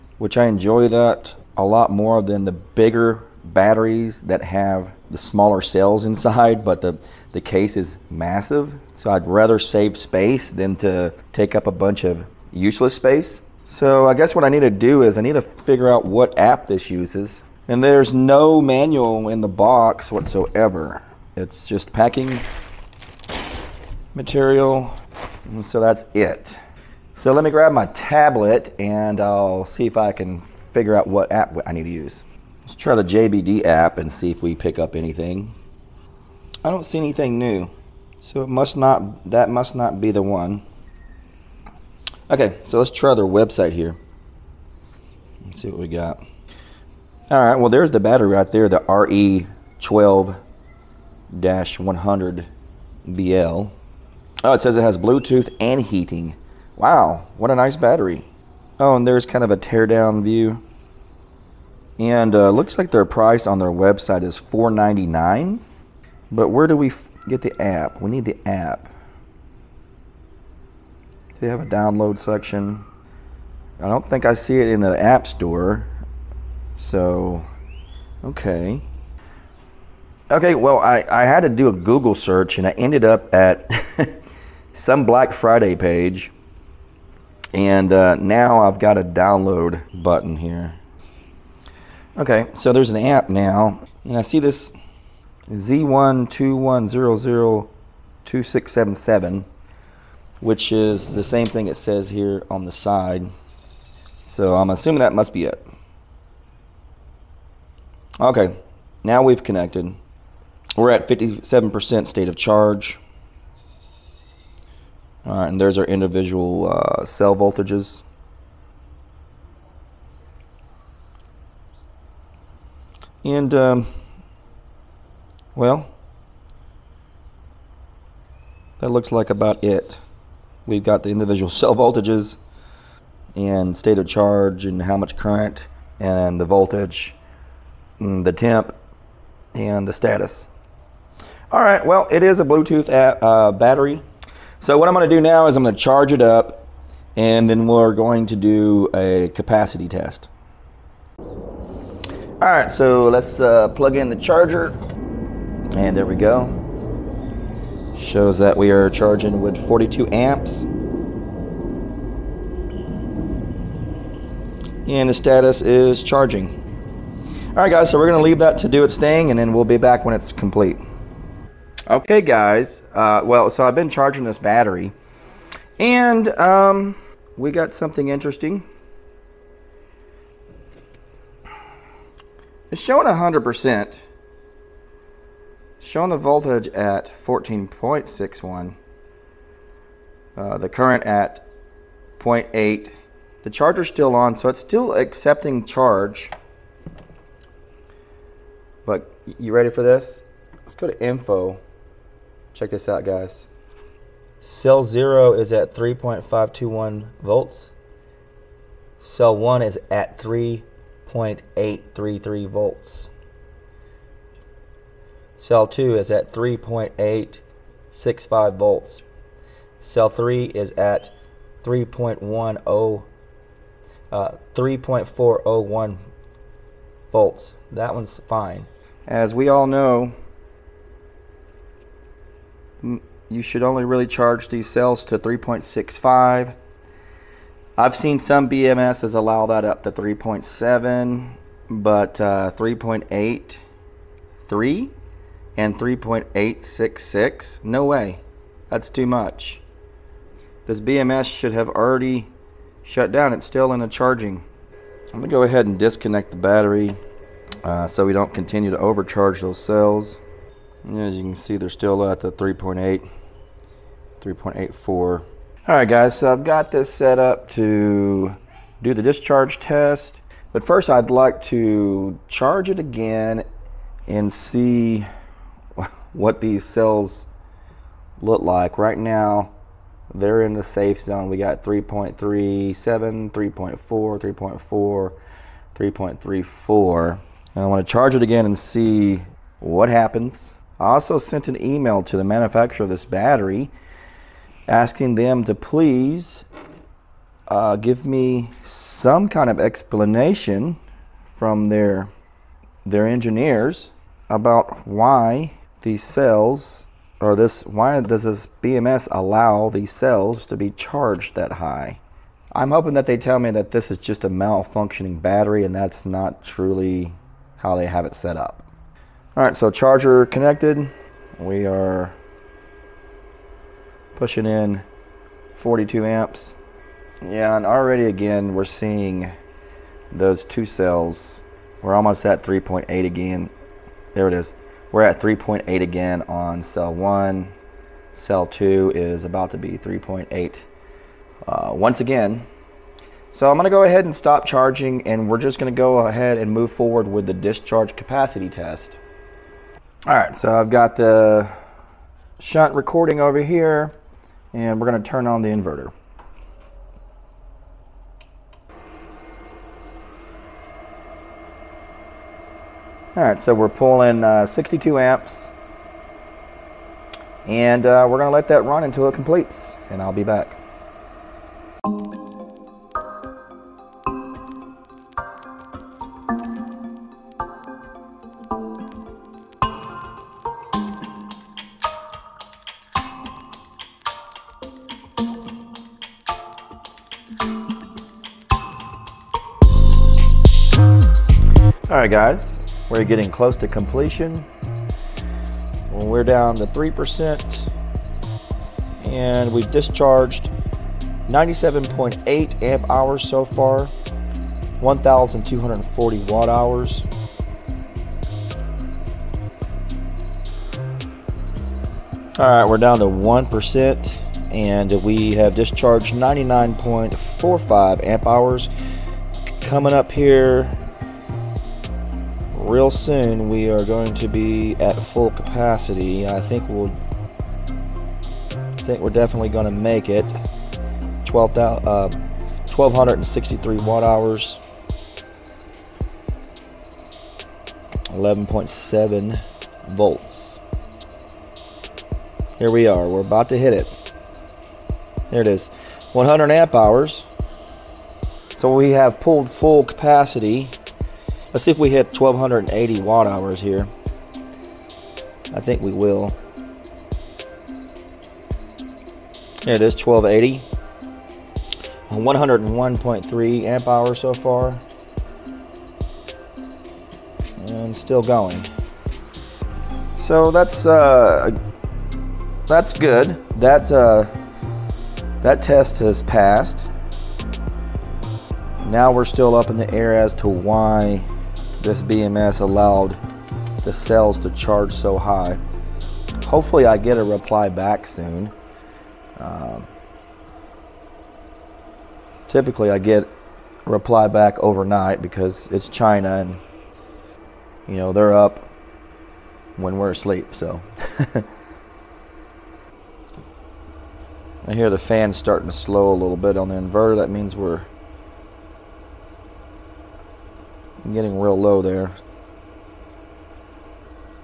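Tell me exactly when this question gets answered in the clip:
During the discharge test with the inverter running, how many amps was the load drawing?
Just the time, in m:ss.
6:04.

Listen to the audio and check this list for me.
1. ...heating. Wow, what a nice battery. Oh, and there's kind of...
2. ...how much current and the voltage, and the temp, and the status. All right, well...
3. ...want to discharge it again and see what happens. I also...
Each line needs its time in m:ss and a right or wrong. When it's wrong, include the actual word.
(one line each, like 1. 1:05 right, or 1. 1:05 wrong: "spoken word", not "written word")
1. 0:55 right
2. 2:14 right
3. 4:47 wrong: "charge", not "discharge".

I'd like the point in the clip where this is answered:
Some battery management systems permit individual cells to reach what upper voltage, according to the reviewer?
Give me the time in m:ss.
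3:59.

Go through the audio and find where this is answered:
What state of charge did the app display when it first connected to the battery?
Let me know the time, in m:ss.
1:51.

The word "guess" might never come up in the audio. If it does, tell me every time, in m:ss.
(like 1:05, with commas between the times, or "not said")
0:14.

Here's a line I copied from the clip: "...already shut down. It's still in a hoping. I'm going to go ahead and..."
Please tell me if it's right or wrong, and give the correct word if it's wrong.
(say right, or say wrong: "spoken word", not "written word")
wrong: "charging", not "hoping".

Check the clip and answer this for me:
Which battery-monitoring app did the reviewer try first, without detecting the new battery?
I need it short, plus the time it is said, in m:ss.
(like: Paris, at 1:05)
JBD, at 0:33.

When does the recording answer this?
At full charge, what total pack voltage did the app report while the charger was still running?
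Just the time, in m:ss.
3:07.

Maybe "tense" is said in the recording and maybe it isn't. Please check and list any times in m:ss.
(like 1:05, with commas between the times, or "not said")
not said.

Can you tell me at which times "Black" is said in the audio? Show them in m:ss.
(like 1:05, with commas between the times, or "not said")
1:25.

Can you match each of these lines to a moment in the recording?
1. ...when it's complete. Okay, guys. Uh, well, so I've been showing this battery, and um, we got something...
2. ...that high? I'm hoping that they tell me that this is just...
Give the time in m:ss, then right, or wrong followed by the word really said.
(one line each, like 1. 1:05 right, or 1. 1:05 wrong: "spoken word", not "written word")
1. 2:50 wrong: "charging", not "showing"
2. 5:11 right.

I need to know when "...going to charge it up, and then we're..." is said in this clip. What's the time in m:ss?
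2:25.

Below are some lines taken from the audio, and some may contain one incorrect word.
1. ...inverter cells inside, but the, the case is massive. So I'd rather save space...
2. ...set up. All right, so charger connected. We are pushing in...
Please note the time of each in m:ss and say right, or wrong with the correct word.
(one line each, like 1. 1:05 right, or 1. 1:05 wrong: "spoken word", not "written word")
1. 0:05 wrong: "smaller", not "inverter"
2. 5:18 right.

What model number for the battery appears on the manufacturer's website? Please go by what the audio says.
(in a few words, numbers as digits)
RE12-100BL.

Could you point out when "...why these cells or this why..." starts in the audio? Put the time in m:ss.
5:04.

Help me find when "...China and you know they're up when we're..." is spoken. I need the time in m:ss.
8:15.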